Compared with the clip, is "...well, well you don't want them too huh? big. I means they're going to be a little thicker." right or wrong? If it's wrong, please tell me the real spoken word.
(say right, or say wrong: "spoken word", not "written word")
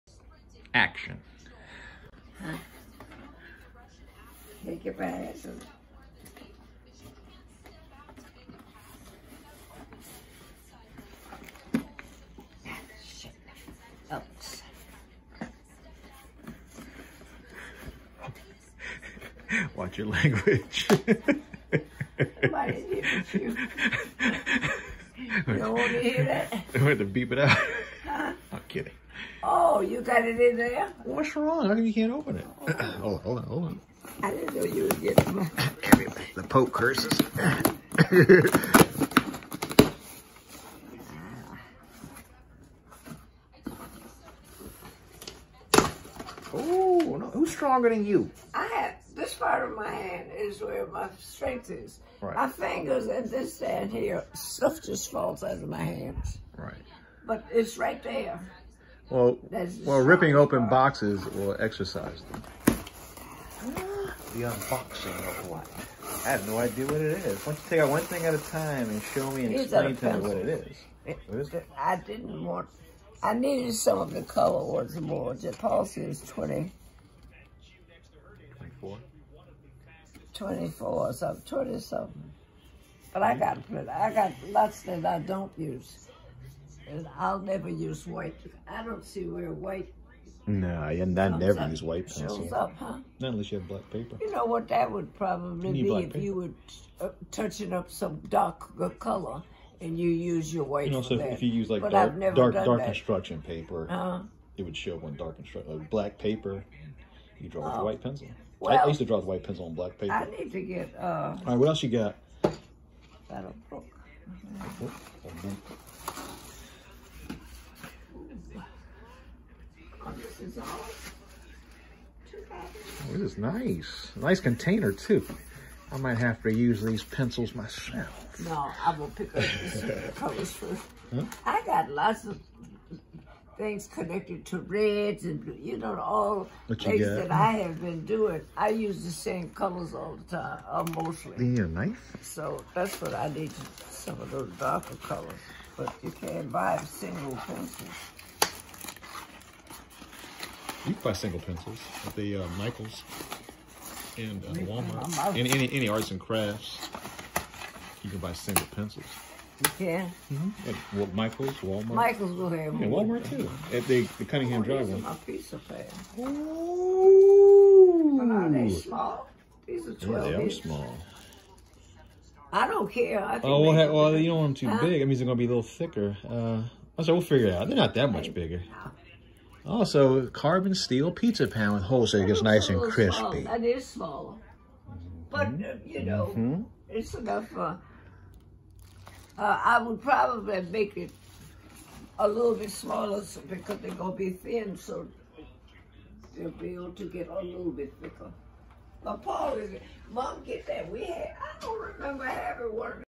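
right.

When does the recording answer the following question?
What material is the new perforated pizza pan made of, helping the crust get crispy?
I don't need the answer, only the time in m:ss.
3:00.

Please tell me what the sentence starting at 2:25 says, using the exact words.
But you can't buy single pencils.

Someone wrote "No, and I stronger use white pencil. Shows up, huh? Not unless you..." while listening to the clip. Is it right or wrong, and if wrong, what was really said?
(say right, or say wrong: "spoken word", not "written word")
wrong: "never", not "stronger".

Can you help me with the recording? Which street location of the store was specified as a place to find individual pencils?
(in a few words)
Cunningham Drive.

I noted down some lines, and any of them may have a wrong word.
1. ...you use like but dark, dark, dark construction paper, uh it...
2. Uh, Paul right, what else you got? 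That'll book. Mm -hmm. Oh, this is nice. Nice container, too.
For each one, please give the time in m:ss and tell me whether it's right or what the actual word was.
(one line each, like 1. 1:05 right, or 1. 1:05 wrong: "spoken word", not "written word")
1. 1:41 right
2. 1:50 wrong: "All", not "Paul".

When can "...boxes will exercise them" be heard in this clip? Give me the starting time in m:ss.
1:00.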